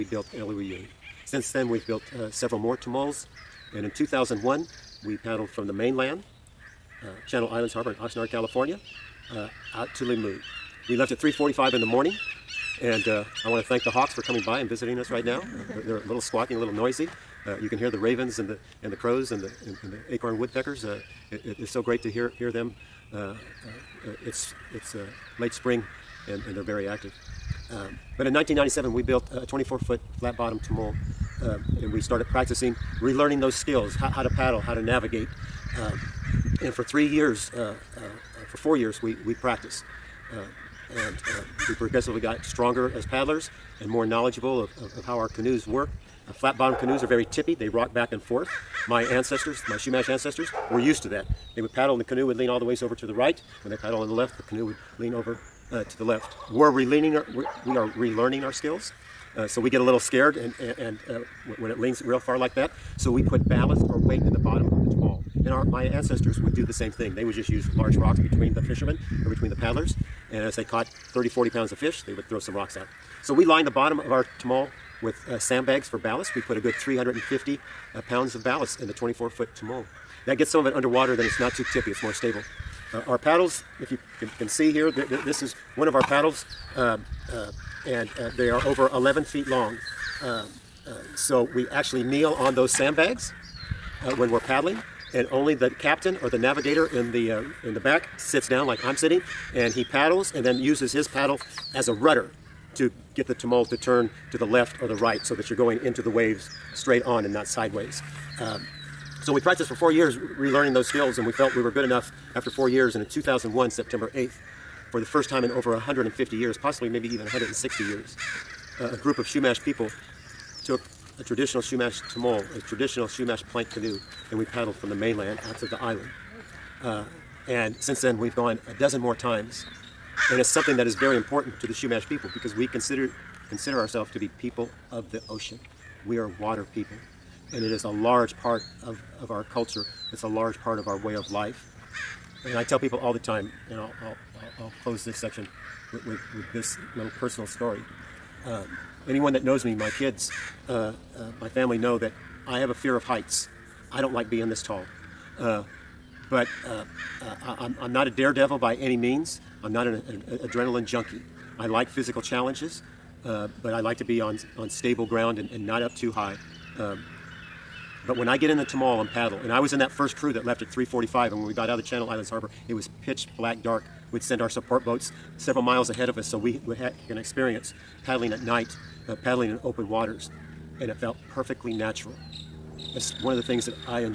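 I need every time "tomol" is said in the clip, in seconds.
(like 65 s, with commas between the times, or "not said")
2 s, 30 s, 64 s, 74 s, 79 s, 103 s, 122 s, 168 s.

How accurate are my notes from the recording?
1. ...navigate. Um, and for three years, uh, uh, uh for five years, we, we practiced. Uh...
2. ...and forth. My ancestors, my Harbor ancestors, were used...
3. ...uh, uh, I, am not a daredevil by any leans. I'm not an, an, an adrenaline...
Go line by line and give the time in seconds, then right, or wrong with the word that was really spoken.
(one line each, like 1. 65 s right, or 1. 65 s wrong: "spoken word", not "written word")
1. 34 s wrong: "four", not "five"
2. 48 s wrong: "Chumash", not "Harbor"
3. 156 s wrong: "means", not "leans".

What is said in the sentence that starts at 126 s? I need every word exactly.
Uh, and since then, we've gone a dozen more times.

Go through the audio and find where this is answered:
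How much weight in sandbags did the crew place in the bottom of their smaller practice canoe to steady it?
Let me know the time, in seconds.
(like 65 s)
76 s.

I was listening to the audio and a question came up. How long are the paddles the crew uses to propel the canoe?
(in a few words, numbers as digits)
Over 11 feet.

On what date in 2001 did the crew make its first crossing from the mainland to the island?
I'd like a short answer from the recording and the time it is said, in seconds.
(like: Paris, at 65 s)
September 8th, at 113 s.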